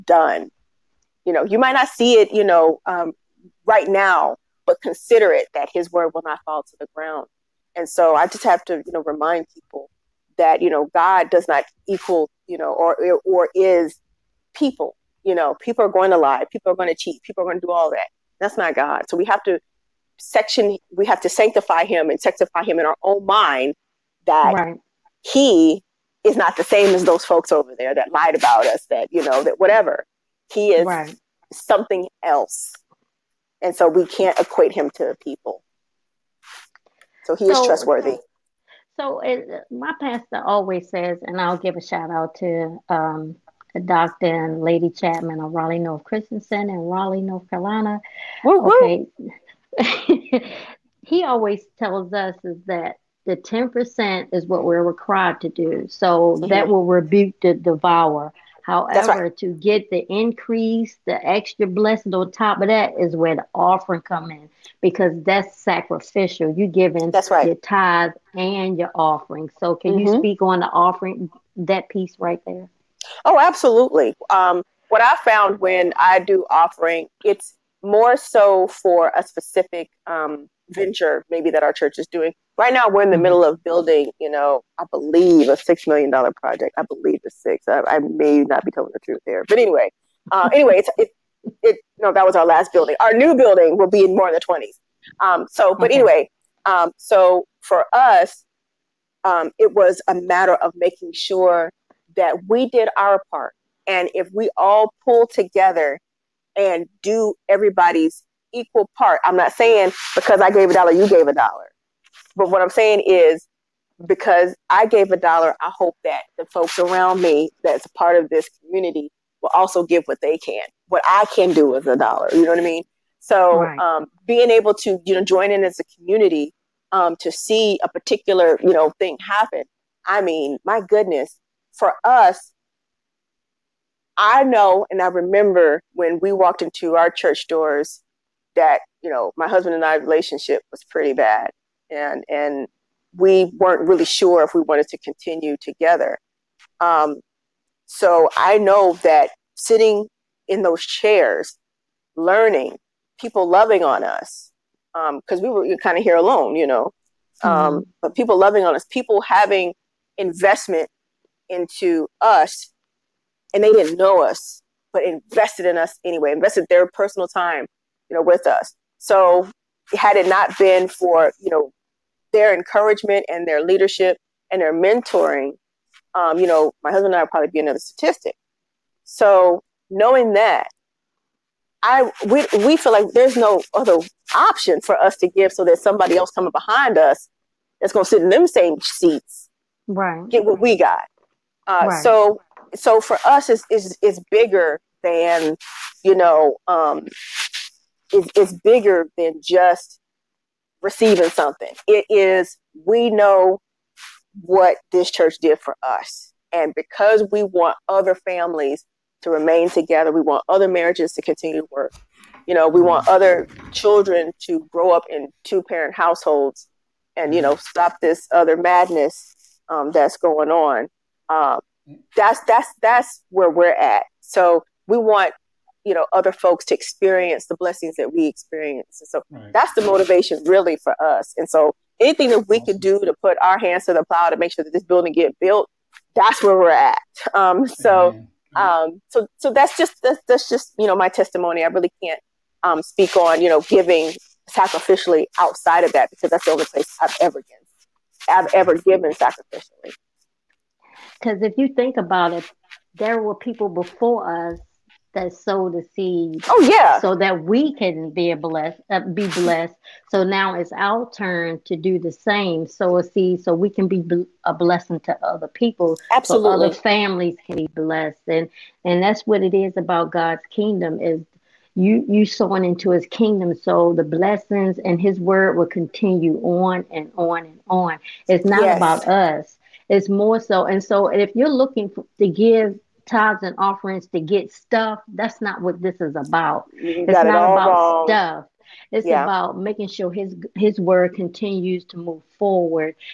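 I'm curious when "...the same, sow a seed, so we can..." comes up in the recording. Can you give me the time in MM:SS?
04:21.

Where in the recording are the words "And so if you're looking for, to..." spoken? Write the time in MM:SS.
04:40.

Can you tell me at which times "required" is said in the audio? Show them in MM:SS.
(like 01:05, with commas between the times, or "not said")
00:54.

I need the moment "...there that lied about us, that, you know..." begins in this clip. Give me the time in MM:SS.
00:27.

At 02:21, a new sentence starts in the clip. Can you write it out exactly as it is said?
And and we weren't really sure if we wanted to continue together.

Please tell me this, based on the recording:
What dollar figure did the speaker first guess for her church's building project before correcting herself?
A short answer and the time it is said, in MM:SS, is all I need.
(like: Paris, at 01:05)
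$6 million, at 01:25.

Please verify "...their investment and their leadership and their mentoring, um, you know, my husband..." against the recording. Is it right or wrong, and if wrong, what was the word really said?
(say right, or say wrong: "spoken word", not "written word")
wrong: "encouragement", not "investment".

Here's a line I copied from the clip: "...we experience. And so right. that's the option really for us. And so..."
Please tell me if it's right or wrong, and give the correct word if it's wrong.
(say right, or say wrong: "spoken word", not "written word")
wrong: "motivation", not "option".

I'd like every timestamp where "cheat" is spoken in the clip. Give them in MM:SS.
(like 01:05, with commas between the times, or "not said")
00:16.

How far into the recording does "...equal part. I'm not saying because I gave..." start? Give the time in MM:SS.
01:48.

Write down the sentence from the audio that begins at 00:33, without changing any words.
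And so we can't equate him to people.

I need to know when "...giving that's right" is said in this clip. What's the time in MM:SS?
01:06.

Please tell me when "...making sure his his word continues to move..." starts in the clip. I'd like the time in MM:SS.
04:49.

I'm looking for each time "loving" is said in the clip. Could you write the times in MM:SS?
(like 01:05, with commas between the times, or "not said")
02:33, 02:38.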